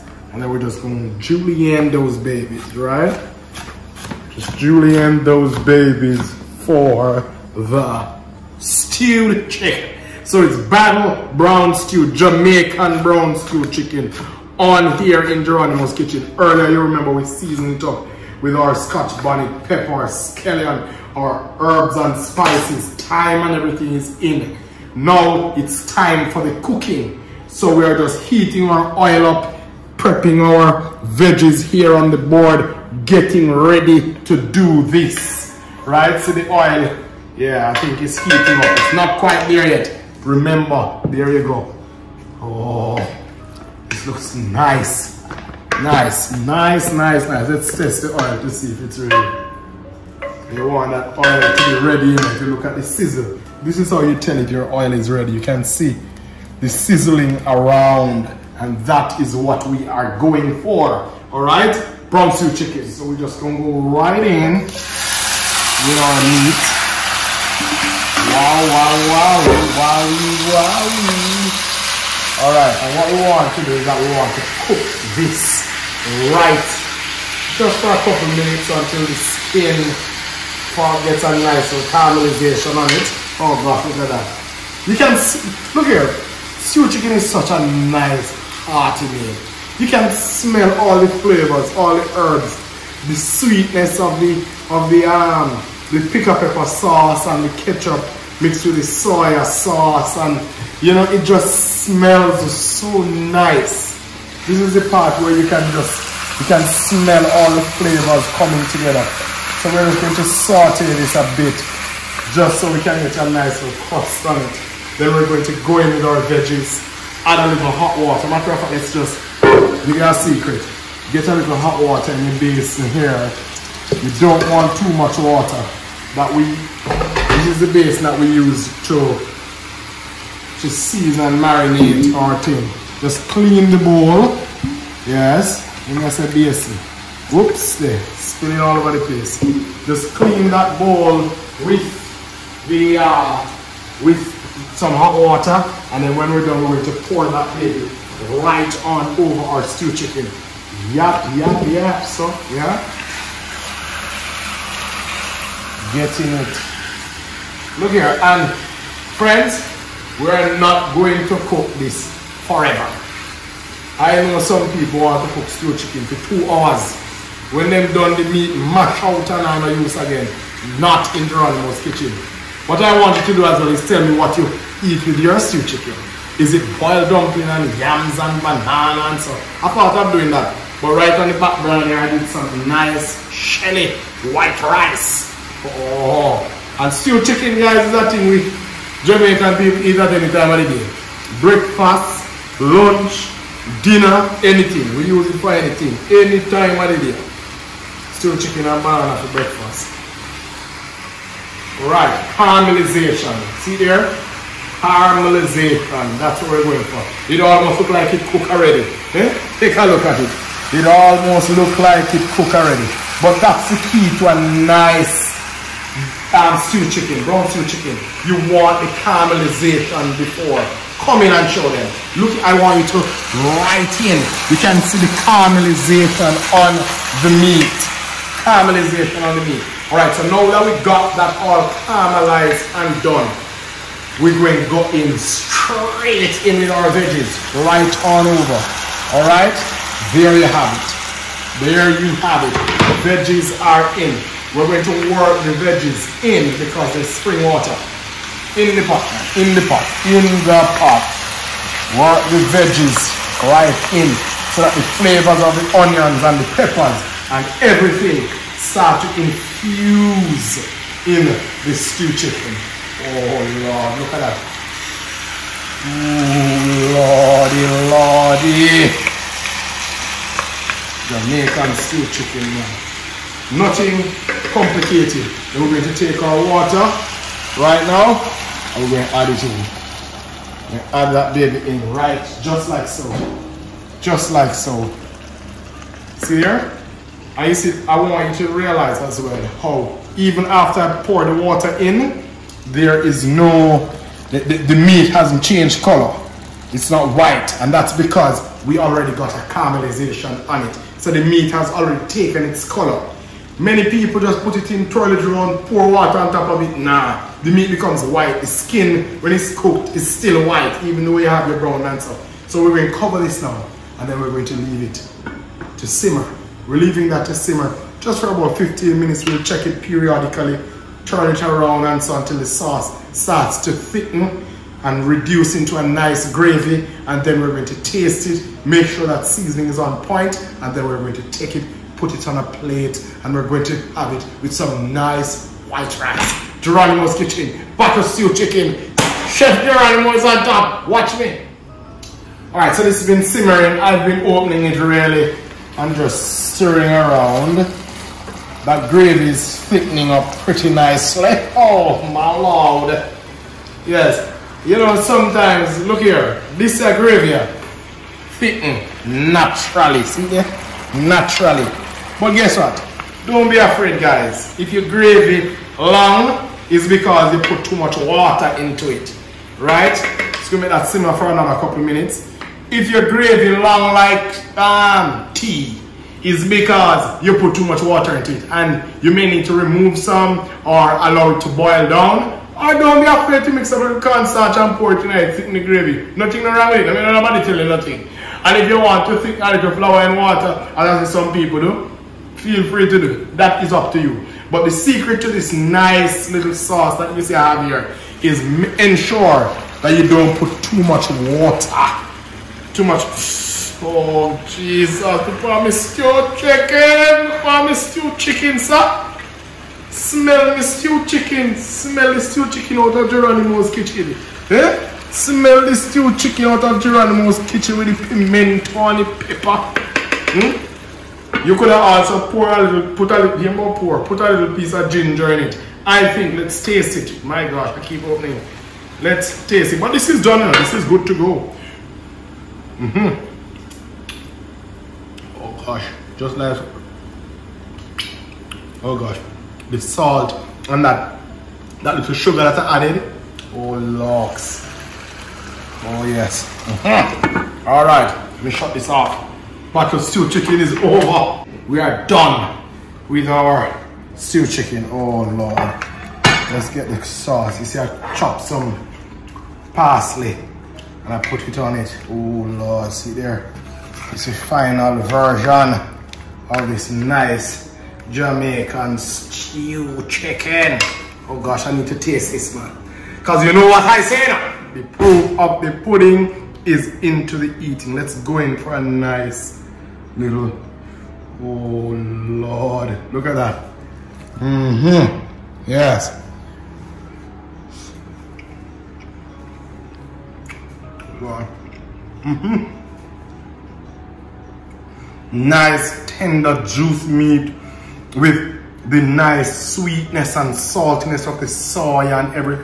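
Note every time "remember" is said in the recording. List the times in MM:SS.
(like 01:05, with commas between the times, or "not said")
00:16, 00:40.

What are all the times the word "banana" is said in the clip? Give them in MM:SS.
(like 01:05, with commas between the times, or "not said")
02:58, 03:18.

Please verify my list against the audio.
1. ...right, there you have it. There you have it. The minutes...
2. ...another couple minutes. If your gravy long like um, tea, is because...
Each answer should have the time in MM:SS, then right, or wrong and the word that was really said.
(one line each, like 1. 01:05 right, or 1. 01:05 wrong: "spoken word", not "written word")
1. 03:59 wrong: "veggies", not "minutes"
2. 06:11 right.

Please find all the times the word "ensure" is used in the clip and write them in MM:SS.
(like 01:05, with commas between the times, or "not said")
06:38.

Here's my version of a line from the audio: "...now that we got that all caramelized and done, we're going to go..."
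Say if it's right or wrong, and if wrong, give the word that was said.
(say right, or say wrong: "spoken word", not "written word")
right.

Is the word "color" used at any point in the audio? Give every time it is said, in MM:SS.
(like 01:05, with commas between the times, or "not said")
04:55, 05:02.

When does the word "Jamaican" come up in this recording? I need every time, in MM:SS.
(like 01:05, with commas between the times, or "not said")
00:12, 03:09, 04:31, 07:48.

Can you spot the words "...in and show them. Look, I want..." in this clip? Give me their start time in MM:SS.
03:41.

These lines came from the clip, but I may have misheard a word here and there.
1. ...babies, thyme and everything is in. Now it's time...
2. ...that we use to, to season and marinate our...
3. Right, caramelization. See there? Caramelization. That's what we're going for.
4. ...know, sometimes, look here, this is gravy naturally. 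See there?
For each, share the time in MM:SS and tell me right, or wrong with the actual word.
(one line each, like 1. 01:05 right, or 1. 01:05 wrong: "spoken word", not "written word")
1. 00:22 wrong: "spices", not "babies"
2. 02:08 right
3. 03:21 right
4. 05:54 right.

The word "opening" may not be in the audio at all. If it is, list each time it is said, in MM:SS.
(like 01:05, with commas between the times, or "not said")
05:44, 07:08.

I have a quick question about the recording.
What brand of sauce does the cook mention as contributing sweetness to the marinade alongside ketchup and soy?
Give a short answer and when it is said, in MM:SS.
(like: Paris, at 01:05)
Pickapeppa, at 01:36.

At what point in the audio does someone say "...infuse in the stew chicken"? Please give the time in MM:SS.
04:19.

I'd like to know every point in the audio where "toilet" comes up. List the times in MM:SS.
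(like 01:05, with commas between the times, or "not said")
05:04.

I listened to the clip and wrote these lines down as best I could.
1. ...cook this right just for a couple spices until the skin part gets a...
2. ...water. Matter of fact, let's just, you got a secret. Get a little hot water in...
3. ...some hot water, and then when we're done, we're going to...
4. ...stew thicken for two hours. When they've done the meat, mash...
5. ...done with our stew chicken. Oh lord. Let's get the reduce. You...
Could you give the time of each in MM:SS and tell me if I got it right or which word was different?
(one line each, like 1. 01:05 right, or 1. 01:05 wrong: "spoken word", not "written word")
1. 01:14 wrong: "minutes", not "spices"
2. 01:57 right
3. 02:24 right
4. 02:45 wrong: "chicken", not "thicken"
5. 07:32 wrong: "sauce", not "reduce".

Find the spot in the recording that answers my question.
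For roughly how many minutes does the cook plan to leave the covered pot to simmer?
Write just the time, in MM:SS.
05:18.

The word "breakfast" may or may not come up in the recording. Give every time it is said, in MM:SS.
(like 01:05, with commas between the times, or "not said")
03:11, 03:19.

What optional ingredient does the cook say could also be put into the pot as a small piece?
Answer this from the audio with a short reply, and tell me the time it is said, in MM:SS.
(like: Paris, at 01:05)
ginger, at 07:04.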